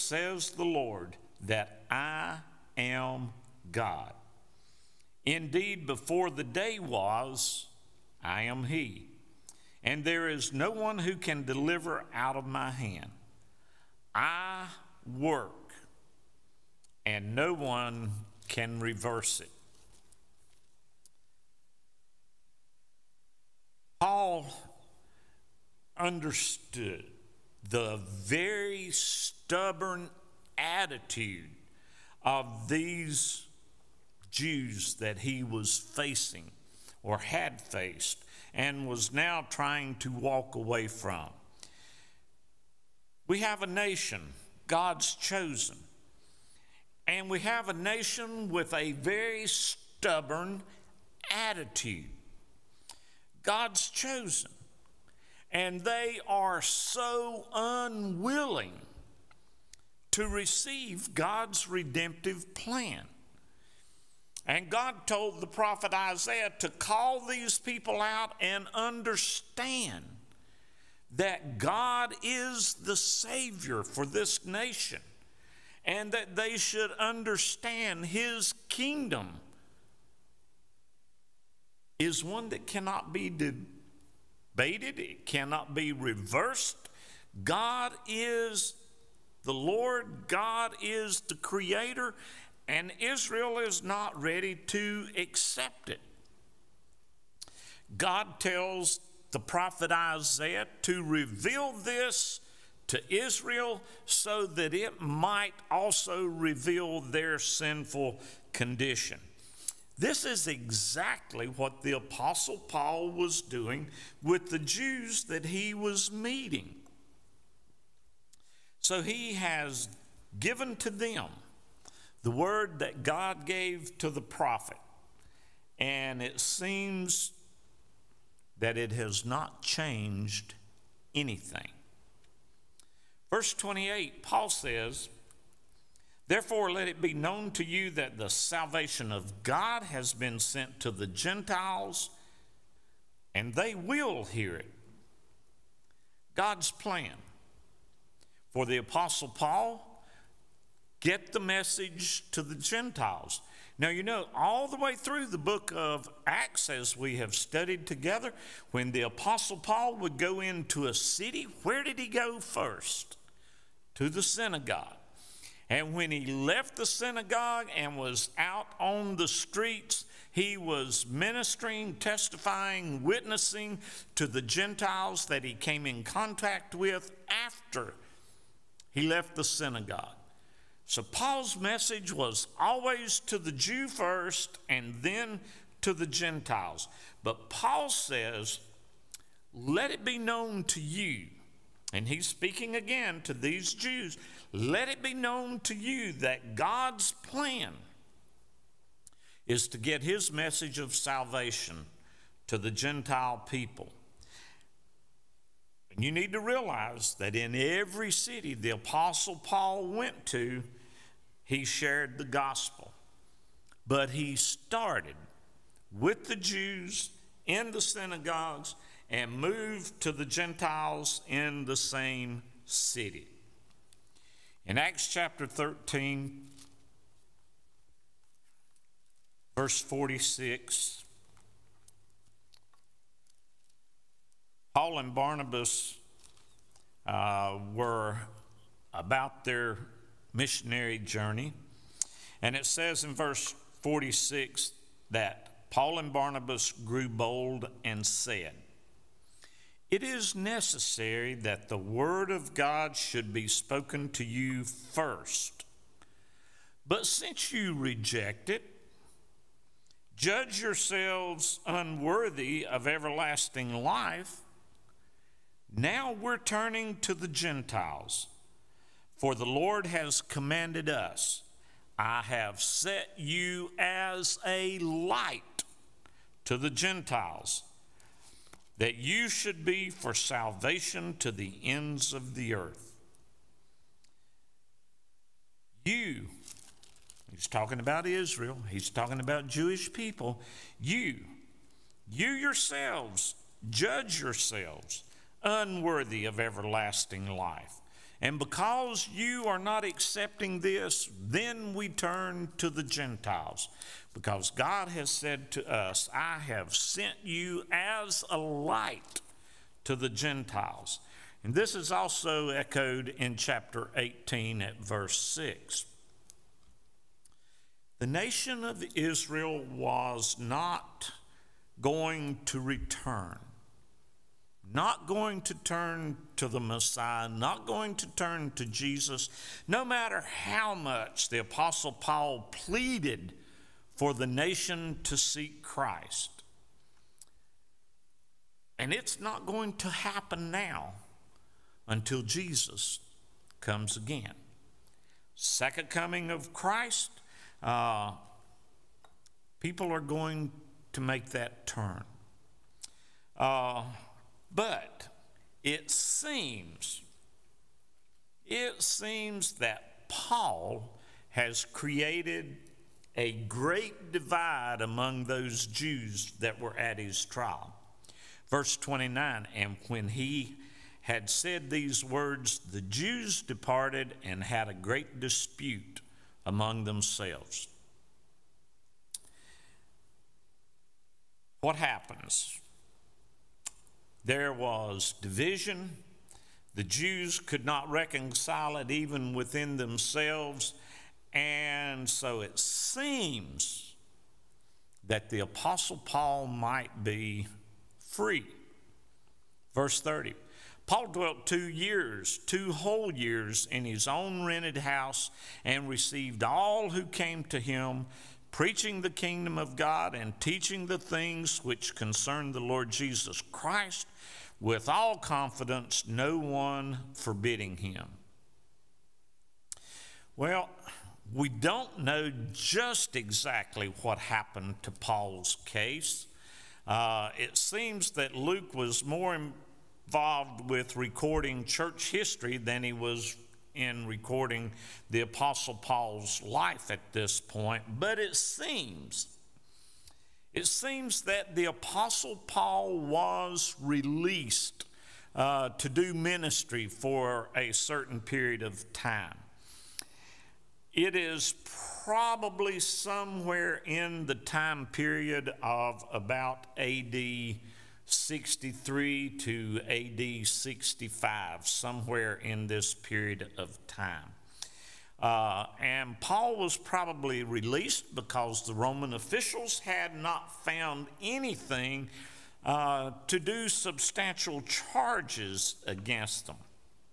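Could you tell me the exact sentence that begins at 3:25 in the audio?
And you need to realize that in every city the Apostle Paul went to, he shared the gospel.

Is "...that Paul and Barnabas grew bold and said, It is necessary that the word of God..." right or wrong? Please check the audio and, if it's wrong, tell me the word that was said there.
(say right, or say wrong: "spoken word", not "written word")
right.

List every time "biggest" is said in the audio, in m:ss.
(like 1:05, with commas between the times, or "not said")
not said.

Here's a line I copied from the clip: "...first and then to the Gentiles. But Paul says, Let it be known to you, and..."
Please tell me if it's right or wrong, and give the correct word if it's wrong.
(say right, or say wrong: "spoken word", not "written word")
right.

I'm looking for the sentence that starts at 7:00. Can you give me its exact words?
Well, we don't know just exactly what happened to Paul's case.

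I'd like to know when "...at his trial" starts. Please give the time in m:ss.
6:06.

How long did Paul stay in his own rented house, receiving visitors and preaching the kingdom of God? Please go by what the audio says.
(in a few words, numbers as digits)
2 years.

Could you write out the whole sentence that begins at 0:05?
Indeed, before the day was, I am He, and there is no one who can deliver out of my hand.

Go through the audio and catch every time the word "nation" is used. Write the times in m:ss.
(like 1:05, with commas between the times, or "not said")
0:43, 0:47, 1:14, 5:18, 5:34.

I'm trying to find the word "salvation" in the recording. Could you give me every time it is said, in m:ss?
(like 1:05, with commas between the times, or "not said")
2:18, 3:20, 4:40.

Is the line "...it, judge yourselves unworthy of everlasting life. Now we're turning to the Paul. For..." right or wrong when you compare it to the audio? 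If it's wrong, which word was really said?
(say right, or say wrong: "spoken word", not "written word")
wrong: "Gentiles", not "Paul".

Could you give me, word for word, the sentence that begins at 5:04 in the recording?
Because God has said to us, I have sent you as a light to the Gentiles.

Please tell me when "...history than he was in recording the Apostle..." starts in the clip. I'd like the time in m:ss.
7:12.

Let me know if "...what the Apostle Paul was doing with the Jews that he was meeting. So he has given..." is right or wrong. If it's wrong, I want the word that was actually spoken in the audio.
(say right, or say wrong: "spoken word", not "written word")
right.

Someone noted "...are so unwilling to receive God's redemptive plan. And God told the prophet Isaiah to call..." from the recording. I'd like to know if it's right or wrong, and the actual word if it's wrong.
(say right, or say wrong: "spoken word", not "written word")
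right.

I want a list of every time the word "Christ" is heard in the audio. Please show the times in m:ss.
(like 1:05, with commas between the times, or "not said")
5:35, 5:46, 6:53.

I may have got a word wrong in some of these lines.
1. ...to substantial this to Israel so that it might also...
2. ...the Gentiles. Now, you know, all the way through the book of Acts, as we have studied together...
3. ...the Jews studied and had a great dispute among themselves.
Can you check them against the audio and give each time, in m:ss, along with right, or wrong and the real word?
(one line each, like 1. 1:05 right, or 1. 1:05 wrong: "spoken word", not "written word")
1. 1:40 wrong: "reveal", not "substantial"
2. 2:32 right
3. 6:12 wrong: "departed", not "studied".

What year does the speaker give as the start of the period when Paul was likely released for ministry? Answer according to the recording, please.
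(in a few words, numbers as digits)
AD 63.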